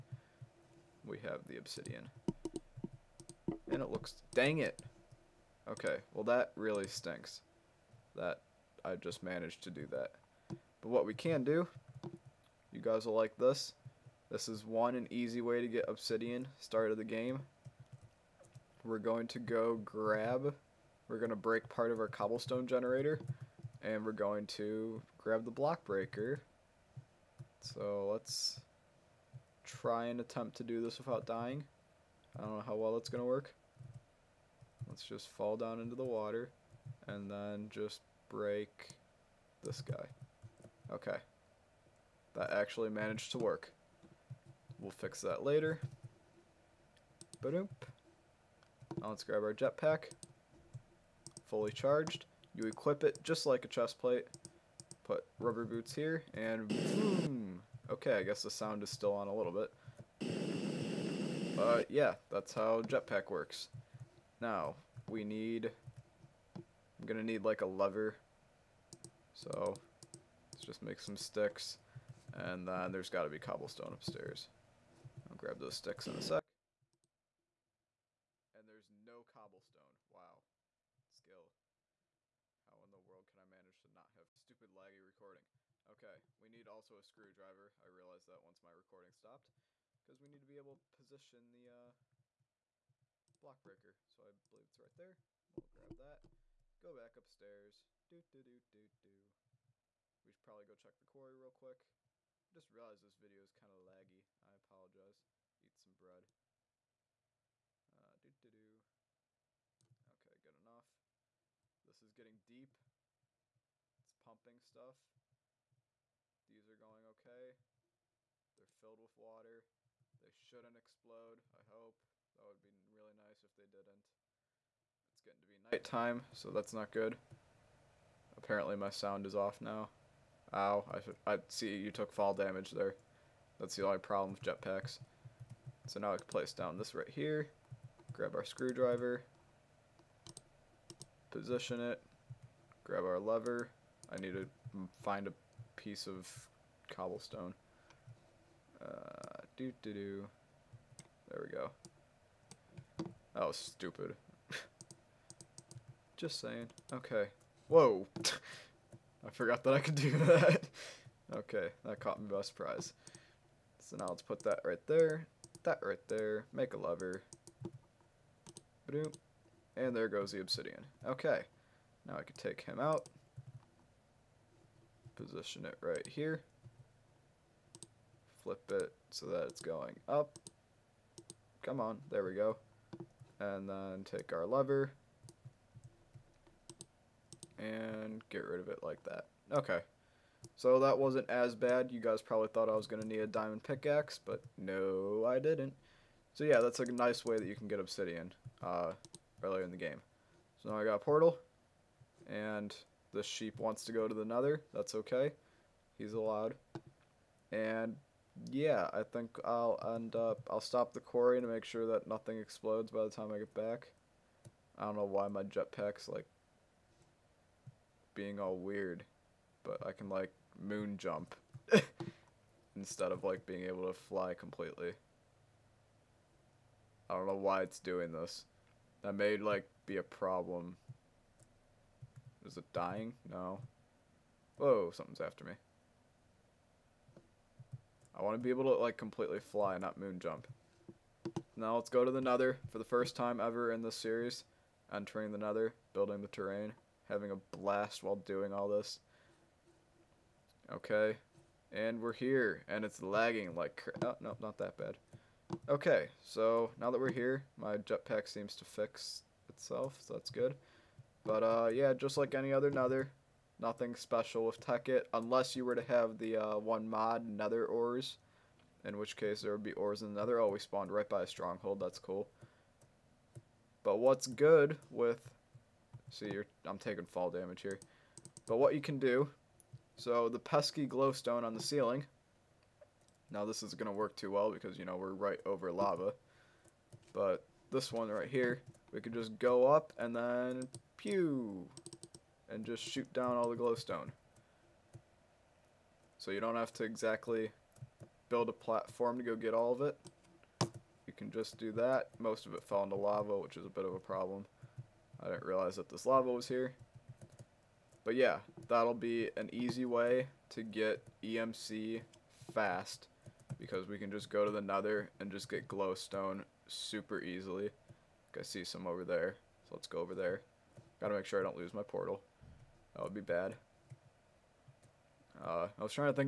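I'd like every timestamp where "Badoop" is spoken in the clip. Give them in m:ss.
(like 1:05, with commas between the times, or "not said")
0:47.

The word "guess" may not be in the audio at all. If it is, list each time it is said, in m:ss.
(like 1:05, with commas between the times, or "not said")
0:58.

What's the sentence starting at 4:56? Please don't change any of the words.
So you don't have to exactly build a platform to go get all of it.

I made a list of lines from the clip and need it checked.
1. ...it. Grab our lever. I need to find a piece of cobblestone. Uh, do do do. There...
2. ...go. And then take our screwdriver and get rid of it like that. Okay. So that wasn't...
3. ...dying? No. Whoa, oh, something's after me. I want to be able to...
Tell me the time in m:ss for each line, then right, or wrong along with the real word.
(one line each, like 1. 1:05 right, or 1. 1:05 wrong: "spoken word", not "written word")
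1. 2:21 right
2. 3:02 wrong: "lever", not "screwdriver"
3. 3:52 right.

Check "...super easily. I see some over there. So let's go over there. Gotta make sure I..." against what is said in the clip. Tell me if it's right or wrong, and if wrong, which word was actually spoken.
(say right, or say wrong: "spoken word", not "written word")
right.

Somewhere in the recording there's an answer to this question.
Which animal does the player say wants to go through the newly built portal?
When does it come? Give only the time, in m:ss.
3:23.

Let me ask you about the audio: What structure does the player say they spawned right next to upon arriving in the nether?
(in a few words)
Stronghold.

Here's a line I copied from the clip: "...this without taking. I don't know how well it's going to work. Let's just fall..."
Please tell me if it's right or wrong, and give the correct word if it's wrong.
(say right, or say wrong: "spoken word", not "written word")
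wrong: "dying", not "taking".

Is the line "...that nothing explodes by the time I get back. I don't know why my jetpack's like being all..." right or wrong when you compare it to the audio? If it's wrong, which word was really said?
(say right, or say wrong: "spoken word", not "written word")
right.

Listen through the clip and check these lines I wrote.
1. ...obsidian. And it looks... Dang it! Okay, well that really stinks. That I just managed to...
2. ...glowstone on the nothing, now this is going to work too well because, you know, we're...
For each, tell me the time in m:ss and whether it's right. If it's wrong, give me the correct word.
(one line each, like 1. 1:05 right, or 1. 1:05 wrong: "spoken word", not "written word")
1. 0:01 right
2. 4:40 wrong: "ceiling", not "nothing".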